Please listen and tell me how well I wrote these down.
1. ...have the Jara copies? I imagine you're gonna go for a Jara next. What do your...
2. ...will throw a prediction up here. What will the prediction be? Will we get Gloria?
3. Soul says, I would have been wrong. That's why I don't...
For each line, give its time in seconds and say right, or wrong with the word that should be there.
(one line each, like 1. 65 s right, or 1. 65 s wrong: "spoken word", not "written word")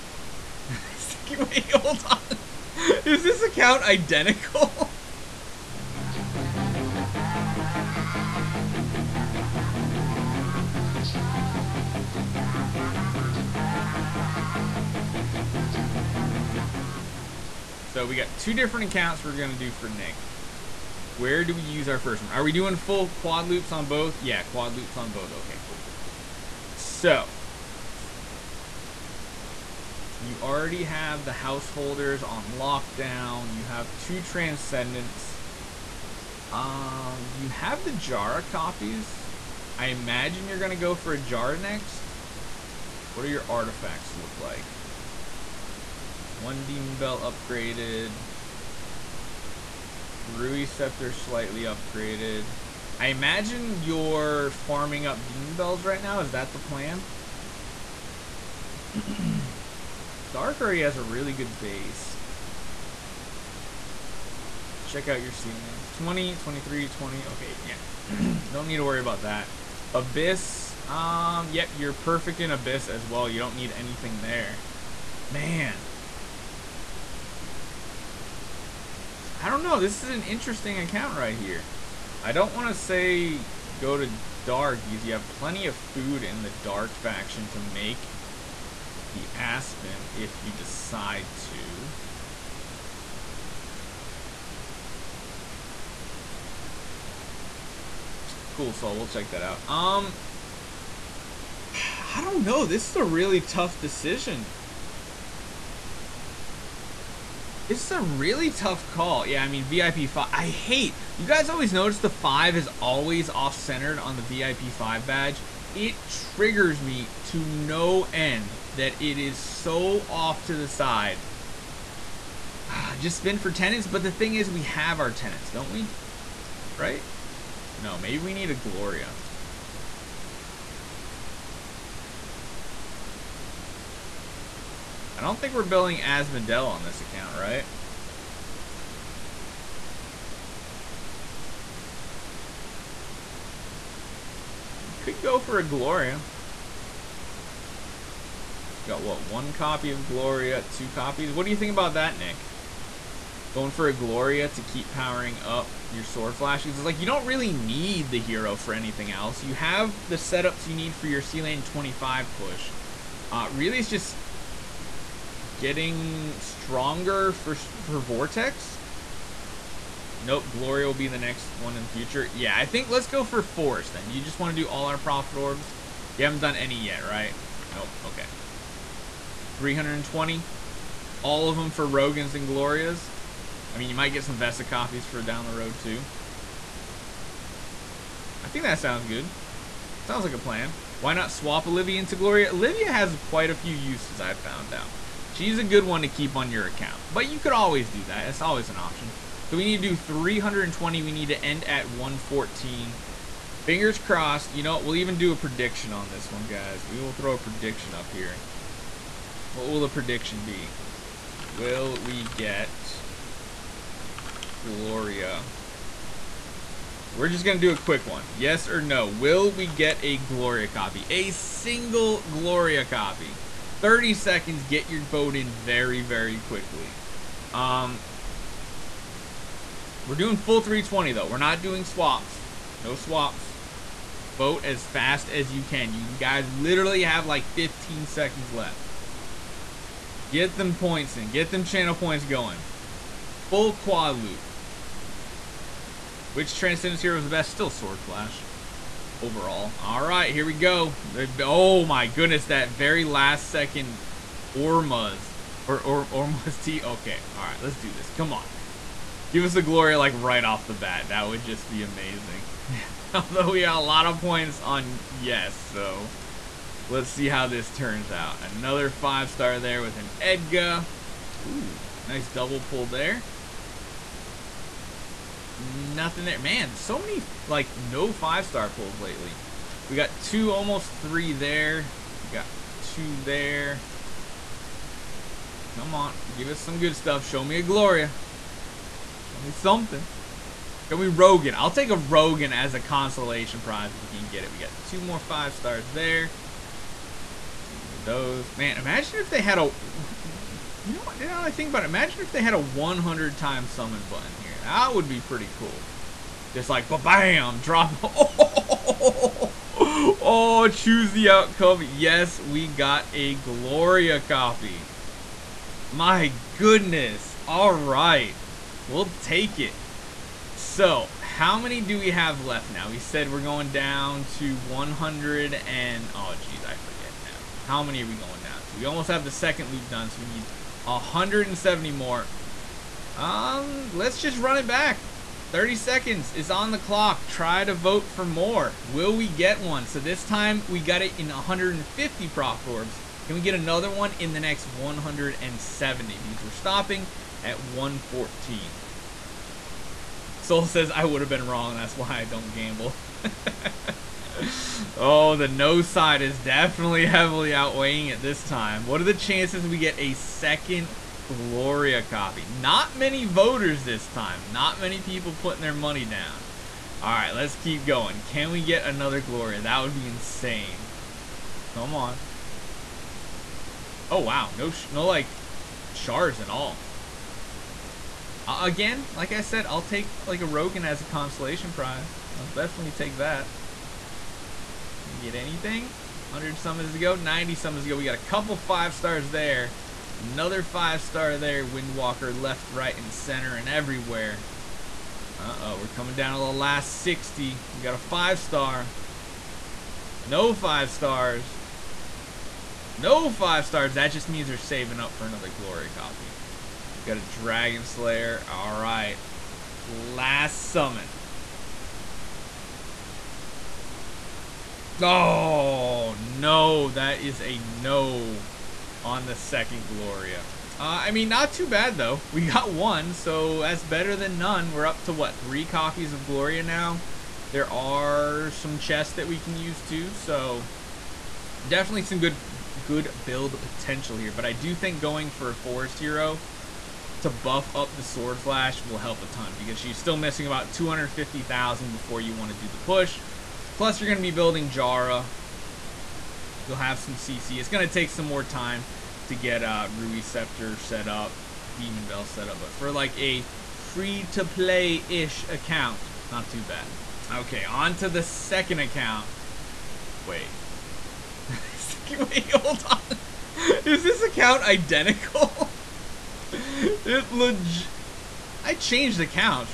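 1. 37 s right
2. 207 s right
3. 350 s right.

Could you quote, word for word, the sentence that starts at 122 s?
Ah, just spin for tenants, but the thing is we have our tenants, don't we?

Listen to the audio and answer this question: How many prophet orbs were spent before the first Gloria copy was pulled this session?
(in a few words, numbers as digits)
150.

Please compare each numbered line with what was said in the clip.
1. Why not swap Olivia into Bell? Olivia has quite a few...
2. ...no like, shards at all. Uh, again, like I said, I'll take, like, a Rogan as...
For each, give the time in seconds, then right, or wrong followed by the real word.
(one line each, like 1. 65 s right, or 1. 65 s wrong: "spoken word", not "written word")
1. 190 s wrong: "Gloria", not "Bell"
2. 374 s right.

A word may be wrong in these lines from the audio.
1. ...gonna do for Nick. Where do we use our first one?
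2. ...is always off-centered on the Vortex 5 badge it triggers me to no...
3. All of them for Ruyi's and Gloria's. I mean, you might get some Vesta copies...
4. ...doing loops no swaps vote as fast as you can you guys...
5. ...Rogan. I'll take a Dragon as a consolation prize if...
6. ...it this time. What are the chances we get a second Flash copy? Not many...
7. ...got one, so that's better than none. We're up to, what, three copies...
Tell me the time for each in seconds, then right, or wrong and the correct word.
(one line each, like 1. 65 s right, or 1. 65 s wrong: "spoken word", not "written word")
1. 19 s right
2. 112 s wrong: "VIP", not "Vortex"
3. 181 s wrong: "Rogan", not "Ruyi"
4. 231 s wrong: "swaps", not "loops"
5. 291 s wrong: "Rogan", not "Dragon"
6. 358 s wrong: "Gloria", not "Flash"
7. 422 s right.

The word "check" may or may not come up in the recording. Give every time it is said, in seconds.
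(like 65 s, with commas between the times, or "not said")
64 s, 99 s.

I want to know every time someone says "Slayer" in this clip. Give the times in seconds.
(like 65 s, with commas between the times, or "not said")
407 s.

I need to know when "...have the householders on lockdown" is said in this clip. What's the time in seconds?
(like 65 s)
30 s.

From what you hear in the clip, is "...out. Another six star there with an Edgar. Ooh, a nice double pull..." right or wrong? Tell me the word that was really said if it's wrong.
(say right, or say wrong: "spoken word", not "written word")
wrong: "five", not "six".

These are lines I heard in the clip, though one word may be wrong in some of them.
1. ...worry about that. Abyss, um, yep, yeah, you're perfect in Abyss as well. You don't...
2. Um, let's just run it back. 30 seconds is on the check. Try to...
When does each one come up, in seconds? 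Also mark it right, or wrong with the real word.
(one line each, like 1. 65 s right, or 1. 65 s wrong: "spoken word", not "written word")
1. 68 s right
2. 333 s wrong: "clock", not "check".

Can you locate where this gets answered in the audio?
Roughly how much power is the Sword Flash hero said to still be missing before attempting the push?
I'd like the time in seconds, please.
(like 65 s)
440 s.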